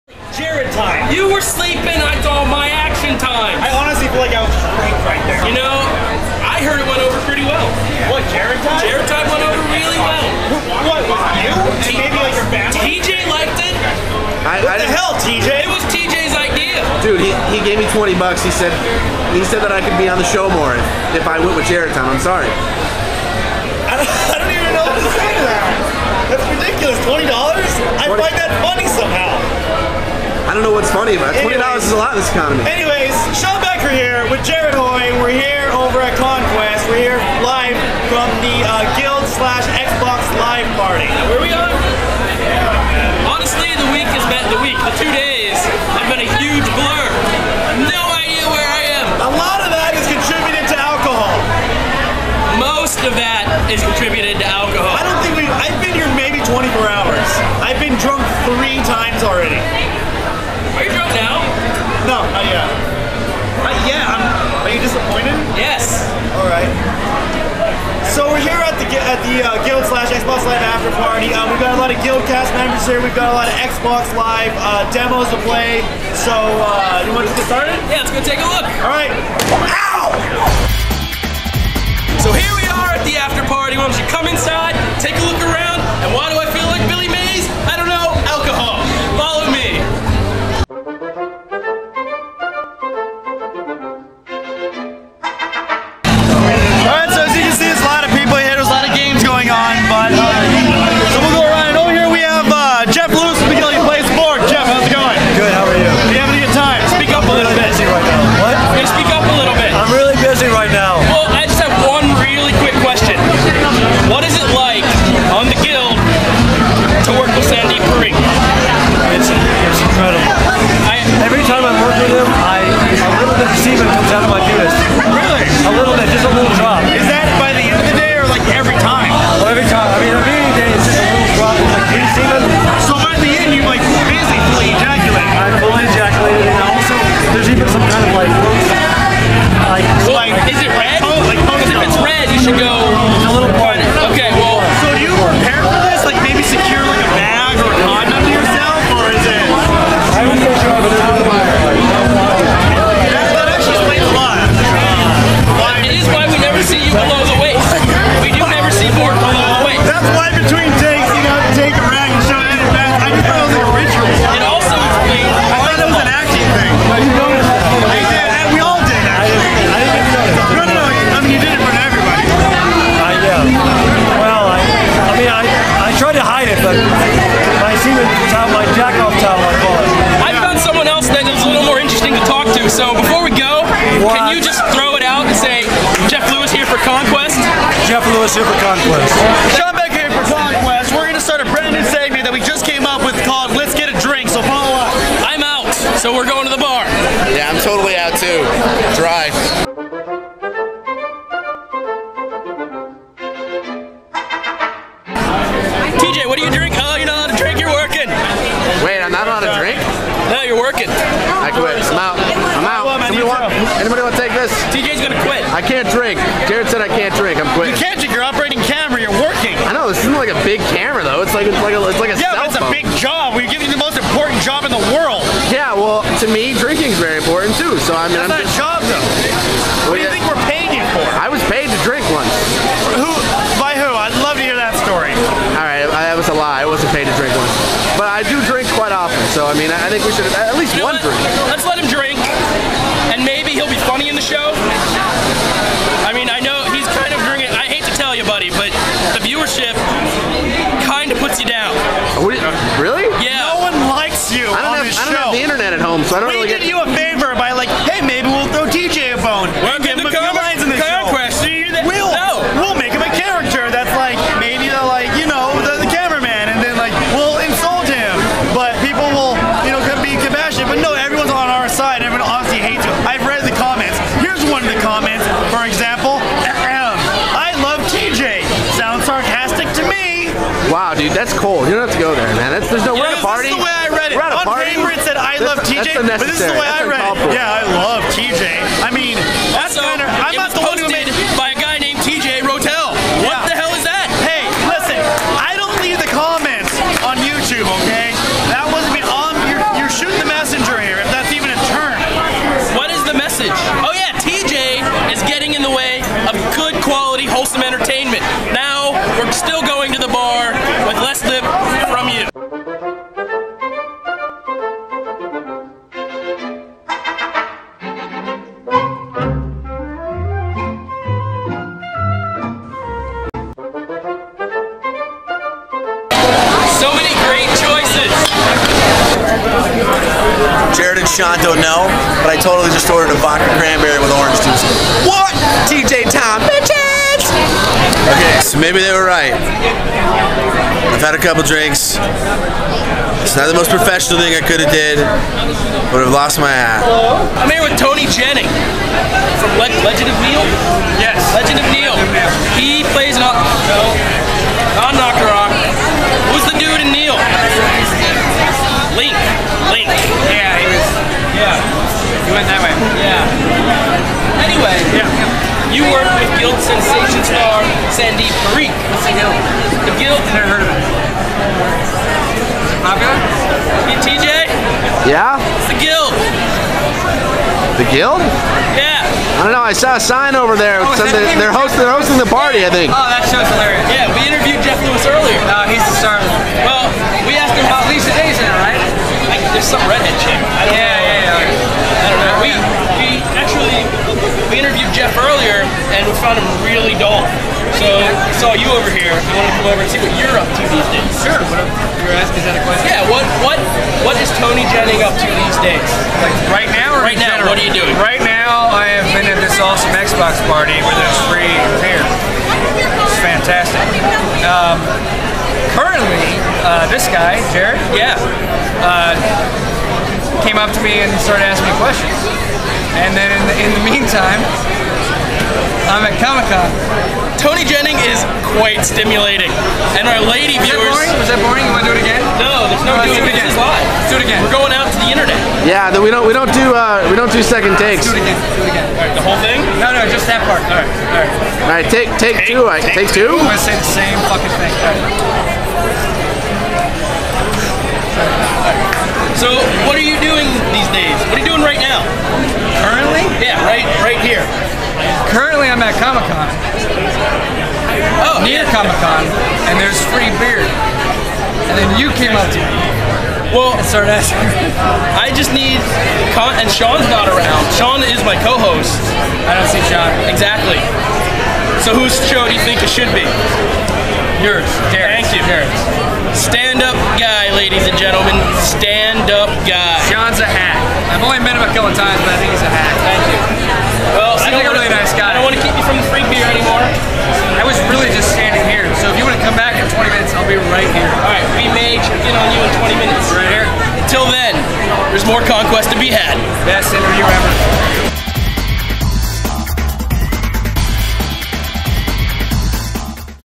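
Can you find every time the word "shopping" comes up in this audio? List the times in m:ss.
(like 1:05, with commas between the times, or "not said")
not said.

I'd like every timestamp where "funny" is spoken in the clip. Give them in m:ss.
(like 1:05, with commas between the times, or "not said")
0:30, 4:03.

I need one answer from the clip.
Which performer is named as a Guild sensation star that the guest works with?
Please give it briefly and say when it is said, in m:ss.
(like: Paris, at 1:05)
Sandeep Parikh, at 6:07.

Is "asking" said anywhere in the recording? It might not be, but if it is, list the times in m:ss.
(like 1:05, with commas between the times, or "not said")
6:42, 7:01, 7:44.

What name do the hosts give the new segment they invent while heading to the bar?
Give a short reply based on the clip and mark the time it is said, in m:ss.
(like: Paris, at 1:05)
Let's Get a Drink, at 3:13.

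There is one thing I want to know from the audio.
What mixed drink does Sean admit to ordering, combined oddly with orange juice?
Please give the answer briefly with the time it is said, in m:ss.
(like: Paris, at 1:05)
vodka cranberry, at 5:33.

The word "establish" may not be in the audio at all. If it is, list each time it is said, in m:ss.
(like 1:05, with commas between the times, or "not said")
not said.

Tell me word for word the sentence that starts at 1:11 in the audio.
Uh, we've got a lot of Guild cast members here.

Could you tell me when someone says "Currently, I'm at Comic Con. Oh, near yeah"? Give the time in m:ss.
7:35.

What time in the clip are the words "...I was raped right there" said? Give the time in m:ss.
0:04.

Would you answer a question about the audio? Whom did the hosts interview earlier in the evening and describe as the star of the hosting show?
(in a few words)
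Jeff Lewis.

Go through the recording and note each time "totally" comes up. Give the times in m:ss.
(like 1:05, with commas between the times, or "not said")
3:17, 5:32.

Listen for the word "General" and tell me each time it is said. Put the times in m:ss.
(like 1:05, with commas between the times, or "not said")
6:47.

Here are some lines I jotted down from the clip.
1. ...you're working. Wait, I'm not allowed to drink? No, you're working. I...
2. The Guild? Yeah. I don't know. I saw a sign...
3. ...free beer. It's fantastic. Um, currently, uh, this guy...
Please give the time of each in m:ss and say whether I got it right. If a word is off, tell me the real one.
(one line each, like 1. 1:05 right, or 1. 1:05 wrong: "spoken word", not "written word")
1. 3:27 right
2. 6:17 right
3. 6:51 right.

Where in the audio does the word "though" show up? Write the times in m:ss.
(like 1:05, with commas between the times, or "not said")
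3:41, 3:48.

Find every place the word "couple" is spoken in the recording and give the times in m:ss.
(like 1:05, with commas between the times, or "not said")
5:41, 8:01.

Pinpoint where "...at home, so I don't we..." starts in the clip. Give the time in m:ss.
4:15.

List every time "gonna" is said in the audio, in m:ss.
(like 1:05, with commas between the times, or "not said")
3:34, 7:23.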